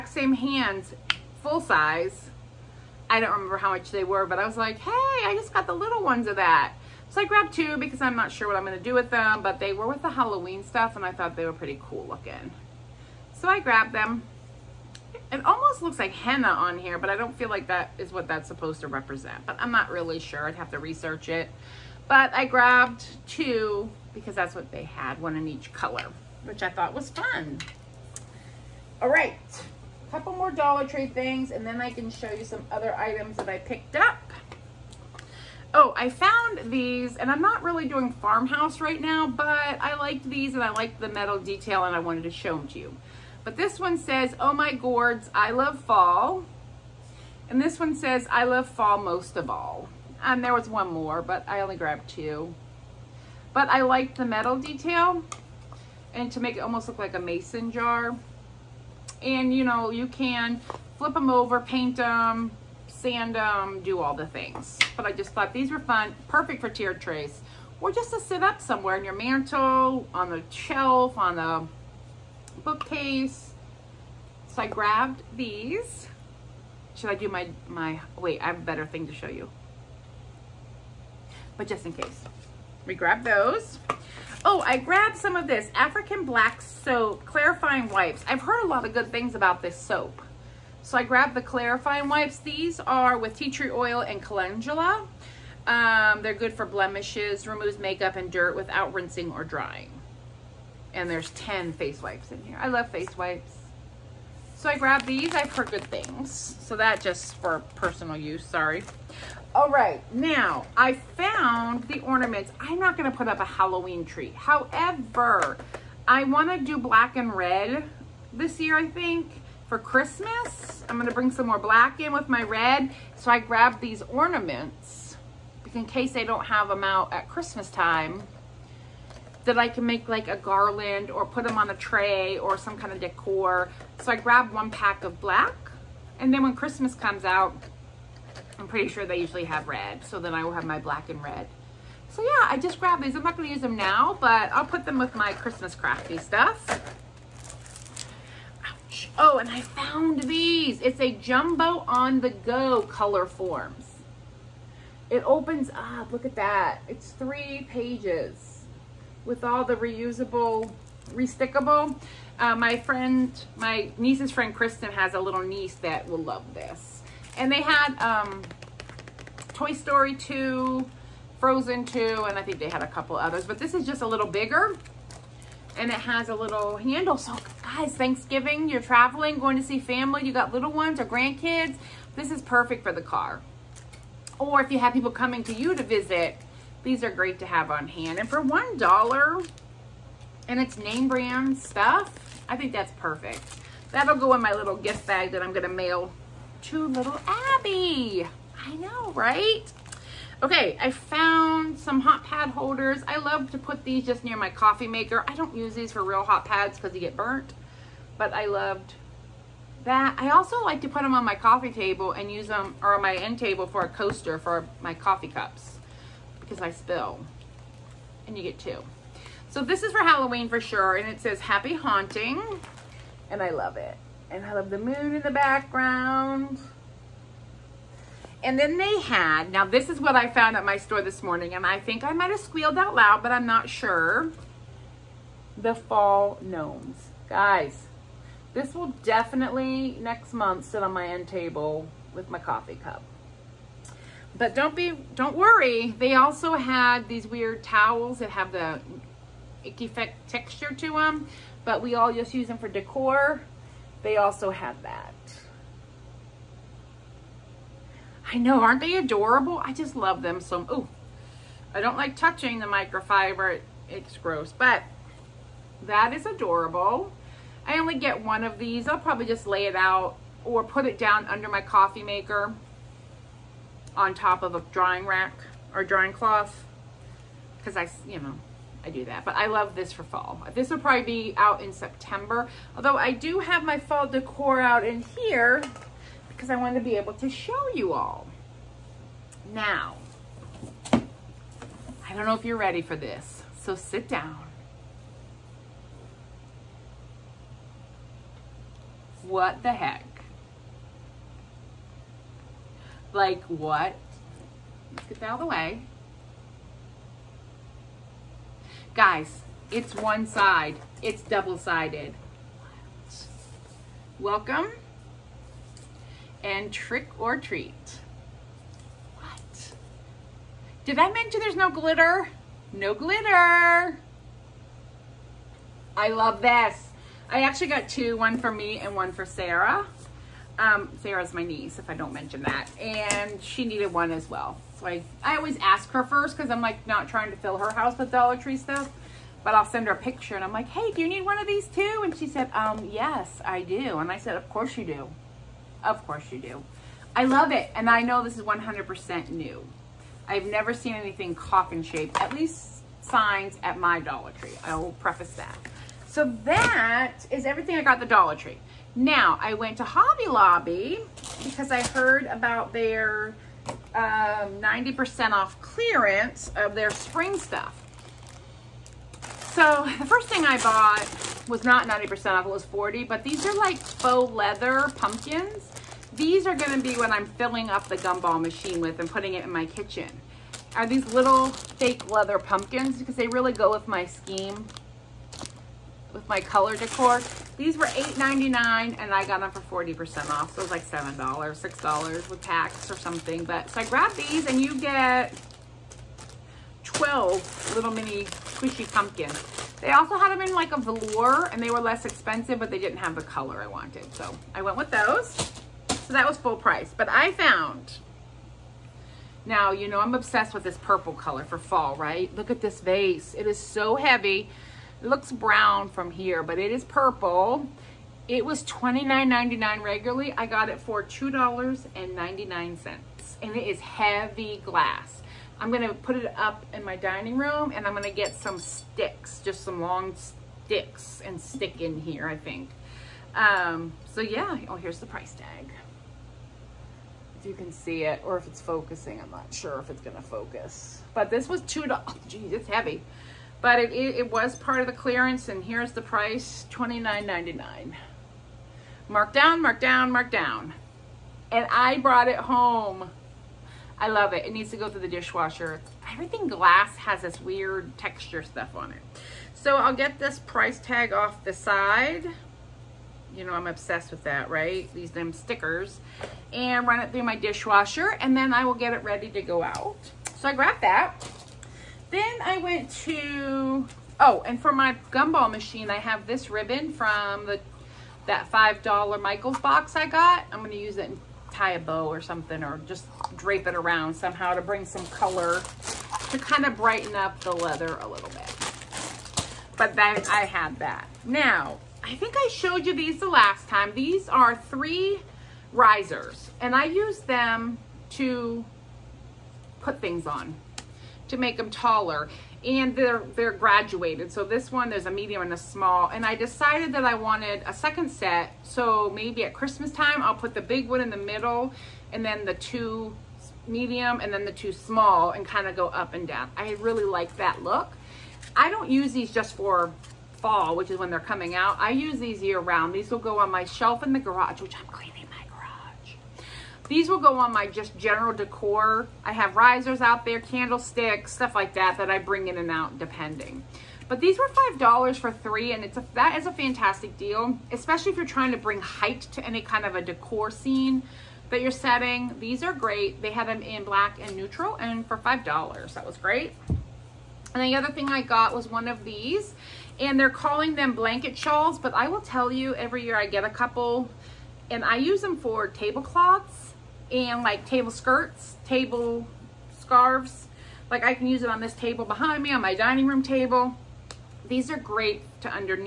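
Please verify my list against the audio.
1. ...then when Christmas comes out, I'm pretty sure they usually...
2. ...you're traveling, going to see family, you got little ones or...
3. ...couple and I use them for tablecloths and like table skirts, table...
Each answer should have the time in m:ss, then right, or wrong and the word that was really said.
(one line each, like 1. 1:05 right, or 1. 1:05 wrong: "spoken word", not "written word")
1. 2:16 right
2. 2:58 right
3. 9:13 right.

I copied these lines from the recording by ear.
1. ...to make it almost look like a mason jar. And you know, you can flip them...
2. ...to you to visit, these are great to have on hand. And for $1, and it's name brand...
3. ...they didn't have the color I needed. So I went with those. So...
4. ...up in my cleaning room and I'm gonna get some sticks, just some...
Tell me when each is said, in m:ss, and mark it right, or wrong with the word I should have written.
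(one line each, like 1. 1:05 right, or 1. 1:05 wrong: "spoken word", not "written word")
1. 0:56 right
2. 3:05 right
3. 6:42 wrong: "wanted", not "needed"
4. 7:06 wrong: "dining", not "cleaning".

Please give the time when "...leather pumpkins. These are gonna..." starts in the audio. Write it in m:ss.
6:14.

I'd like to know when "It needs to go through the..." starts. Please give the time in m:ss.
7:34.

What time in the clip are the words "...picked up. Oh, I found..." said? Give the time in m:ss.
0:33.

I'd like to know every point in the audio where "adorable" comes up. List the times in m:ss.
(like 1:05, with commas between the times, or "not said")
4:18, 4:26.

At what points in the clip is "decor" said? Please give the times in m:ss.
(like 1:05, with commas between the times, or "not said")
2:12, 4:12, 4:44, 6:26, 8:48, 9:00.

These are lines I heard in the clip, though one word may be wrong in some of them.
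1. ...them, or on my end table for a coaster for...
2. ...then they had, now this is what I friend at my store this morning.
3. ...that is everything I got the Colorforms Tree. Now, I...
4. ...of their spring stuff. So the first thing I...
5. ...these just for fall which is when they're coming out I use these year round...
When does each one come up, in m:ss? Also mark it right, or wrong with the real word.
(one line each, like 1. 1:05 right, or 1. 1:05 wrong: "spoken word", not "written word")
1. 3:32 right
2. 3:48 wrong: "found", not "friend"
3. 5:56 wrong: "Dollar", not "Colorforms"
4. 6:06 right
5. 8:39 right.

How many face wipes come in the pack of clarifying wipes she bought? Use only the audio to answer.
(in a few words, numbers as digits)
10.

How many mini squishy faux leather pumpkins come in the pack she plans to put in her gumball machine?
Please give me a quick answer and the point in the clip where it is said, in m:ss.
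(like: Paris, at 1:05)
12, at 6:36.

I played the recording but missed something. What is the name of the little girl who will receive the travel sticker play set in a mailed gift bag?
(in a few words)
Abby.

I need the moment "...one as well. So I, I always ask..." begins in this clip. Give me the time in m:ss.
5:33.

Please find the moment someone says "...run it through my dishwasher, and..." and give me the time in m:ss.
7:46.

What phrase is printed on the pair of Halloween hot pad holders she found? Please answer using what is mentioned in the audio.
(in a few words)
Happy Haunting.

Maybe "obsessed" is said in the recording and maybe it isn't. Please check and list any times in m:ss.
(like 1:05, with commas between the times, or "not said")
6:50, 7:43.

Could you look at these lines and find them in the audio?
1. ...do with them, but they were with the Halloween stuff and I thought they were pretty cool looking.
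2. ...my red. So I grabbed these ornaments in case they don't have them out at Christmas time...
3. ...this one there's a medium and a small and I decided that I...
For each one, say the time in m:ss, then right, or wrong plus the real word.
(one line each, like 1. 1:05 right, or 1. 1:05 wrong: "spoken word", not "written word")
1. 0:08 right
2. 2:02 right
3. 8:24 right.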